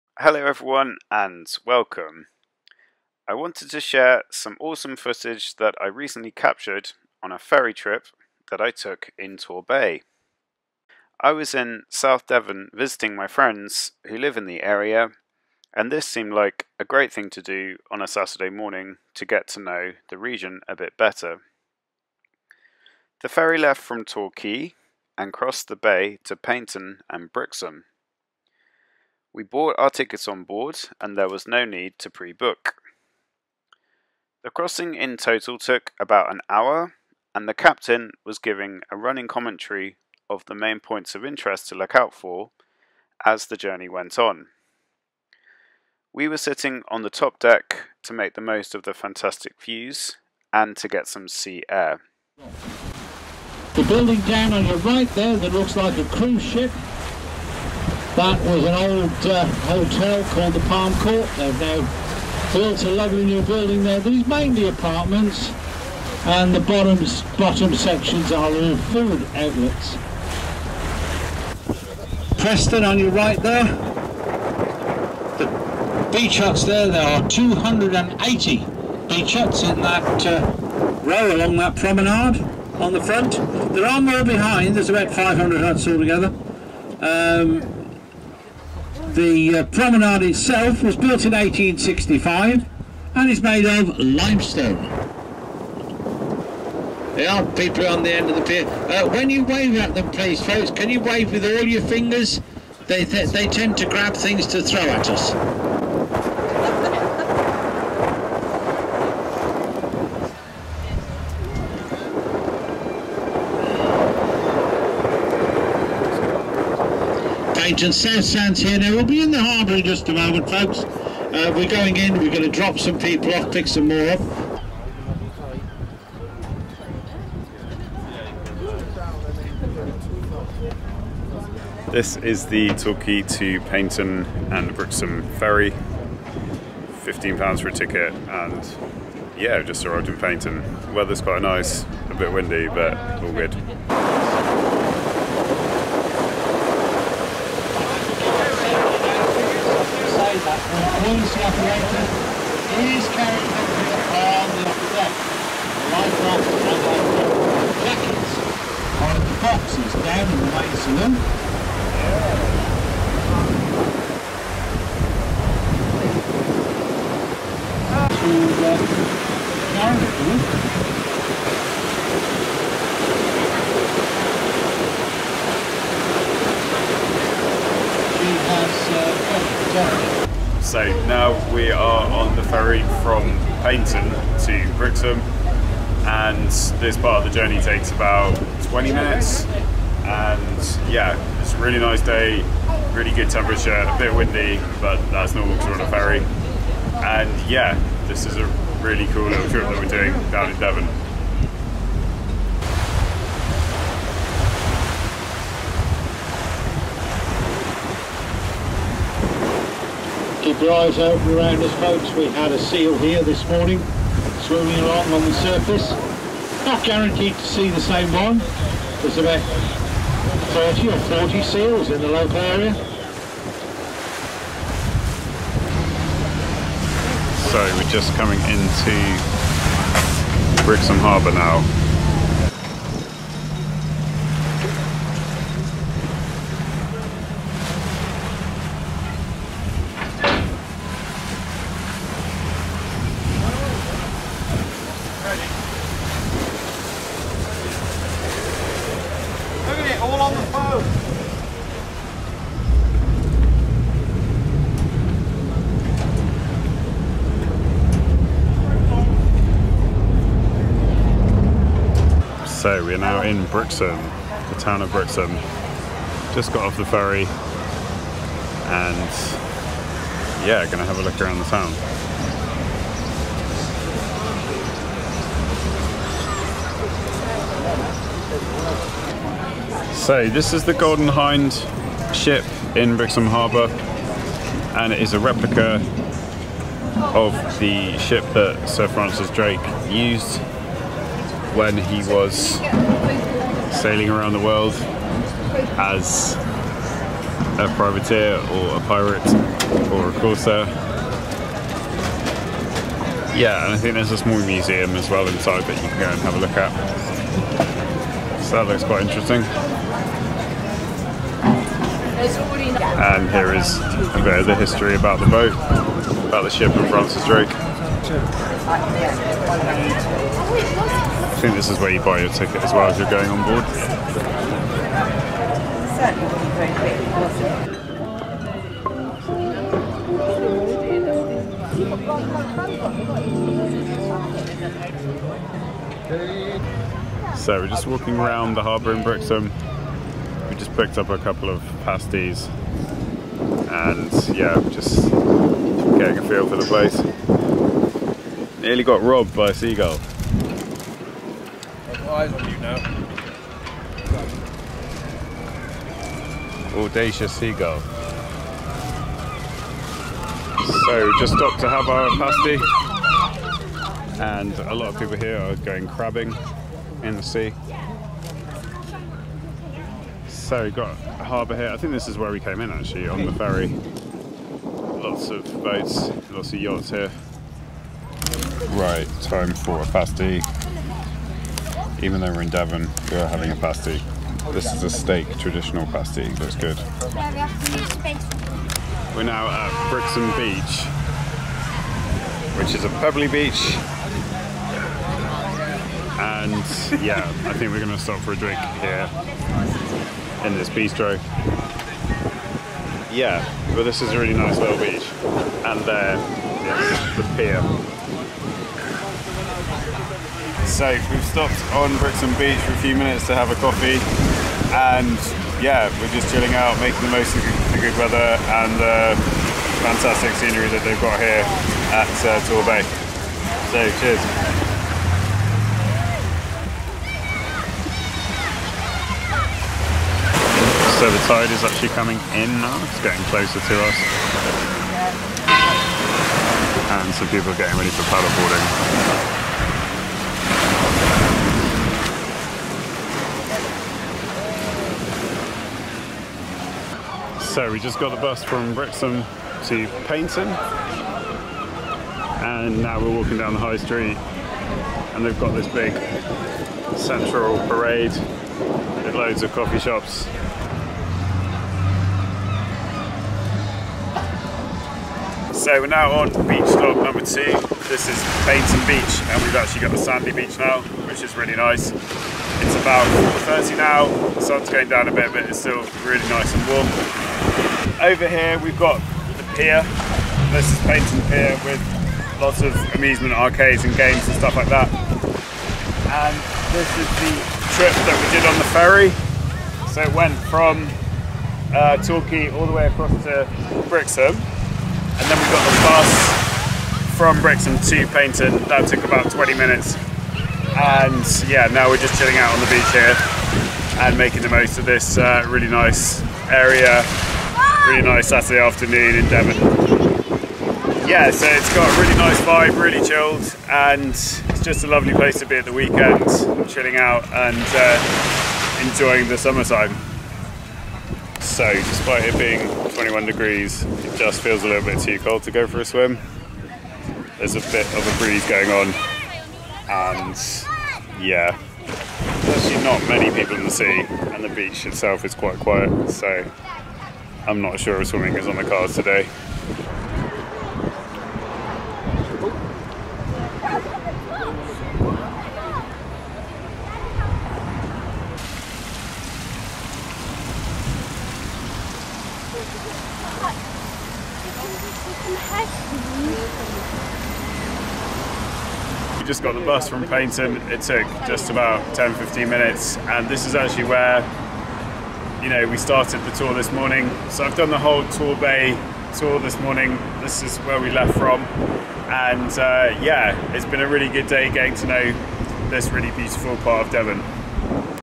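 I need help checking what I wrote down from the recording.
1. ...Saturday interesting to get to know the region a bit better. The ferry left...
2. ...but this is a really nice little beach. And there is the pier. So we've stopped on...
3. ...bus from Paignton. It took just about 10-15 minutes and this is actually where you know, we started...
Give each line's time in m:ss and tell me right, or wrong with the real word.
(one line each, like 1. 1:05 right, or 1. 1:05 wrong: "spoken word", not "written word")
1. 0:18 wrong: "morning", not "interesting"
2. 6:43 right
3. 9:19 right.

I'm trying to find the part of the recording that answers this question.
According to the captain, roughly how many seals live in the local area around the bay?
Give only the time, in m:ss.
3:40.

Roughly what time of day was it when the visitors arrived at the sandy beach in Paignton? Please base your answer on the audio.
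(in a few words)
4.30.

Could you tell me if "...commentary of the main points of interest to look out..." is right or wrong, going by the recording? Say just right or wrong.
right.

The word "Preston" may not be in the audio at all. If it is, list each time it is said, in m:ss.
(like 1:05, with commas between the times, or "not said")
1:12.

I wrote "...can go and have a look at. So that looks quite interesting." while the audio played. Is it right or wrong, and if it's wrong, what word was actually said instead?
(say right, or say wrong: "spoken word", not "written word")
right.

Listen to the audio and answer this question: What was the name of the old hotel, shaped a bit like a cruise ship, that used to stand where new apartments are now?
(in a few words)
Palm Court.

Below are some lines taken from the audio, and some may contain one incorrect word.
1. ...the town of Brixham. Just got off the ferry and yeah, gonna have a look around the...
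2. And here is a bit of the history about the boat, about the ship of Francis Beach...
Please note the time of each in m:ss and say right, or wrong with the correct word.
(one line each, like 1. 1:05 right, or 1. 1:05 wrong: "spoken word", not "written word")
1. 4:24 right
2. 5:13 wrong: "Drake", not "Beach".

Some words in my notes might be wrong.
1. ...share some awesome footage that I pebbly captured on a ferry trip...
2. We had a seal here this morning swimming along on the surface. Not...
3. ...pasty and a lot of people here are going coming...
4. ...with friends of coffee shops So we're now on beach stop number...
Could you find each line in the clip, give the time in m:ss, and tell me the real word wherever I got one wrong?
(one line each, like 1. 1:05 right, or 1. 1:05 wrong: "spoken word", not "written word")
1. 0:03 wrong: "recently", not "pebbly"
2. 3:32 right
3. 6:02 wrong: "crabbing", not "coming"
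4. 7:39 wrong: "loads", not "friends".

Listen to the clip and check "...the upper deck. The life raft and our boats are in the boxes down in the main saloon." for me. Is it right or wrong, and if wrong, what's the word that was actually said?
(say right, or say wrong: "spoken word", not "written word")
wrong: "jackets", not "boats".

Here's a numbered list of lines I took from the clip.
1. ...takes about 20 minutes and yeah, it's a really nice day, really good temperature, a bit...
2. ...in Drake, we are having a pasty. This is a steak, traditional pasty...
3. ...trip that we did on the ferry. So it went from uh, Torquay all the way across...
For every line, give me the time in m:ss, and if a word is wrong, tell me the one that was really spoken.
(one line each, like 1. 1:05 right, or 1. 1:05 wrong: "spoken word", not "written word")
1. 3:07 right
2. 6:22 wrong: "Devon", not "Drake"
3. 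8:07 right.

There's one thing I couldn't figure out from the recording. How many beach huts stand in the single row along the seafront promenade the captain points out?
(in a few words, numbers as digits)
280.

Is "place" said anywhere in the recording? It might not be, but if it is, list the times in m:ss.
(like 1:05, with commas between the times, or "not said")
5:46, 8:35.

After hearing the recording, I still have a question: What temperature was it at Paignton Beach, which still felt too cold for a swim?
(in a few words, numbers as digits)
21 degrees.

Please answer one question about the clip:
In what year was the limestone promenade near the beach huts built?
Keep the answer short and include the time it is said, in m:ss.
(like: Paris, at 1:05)
1865, at 1:31.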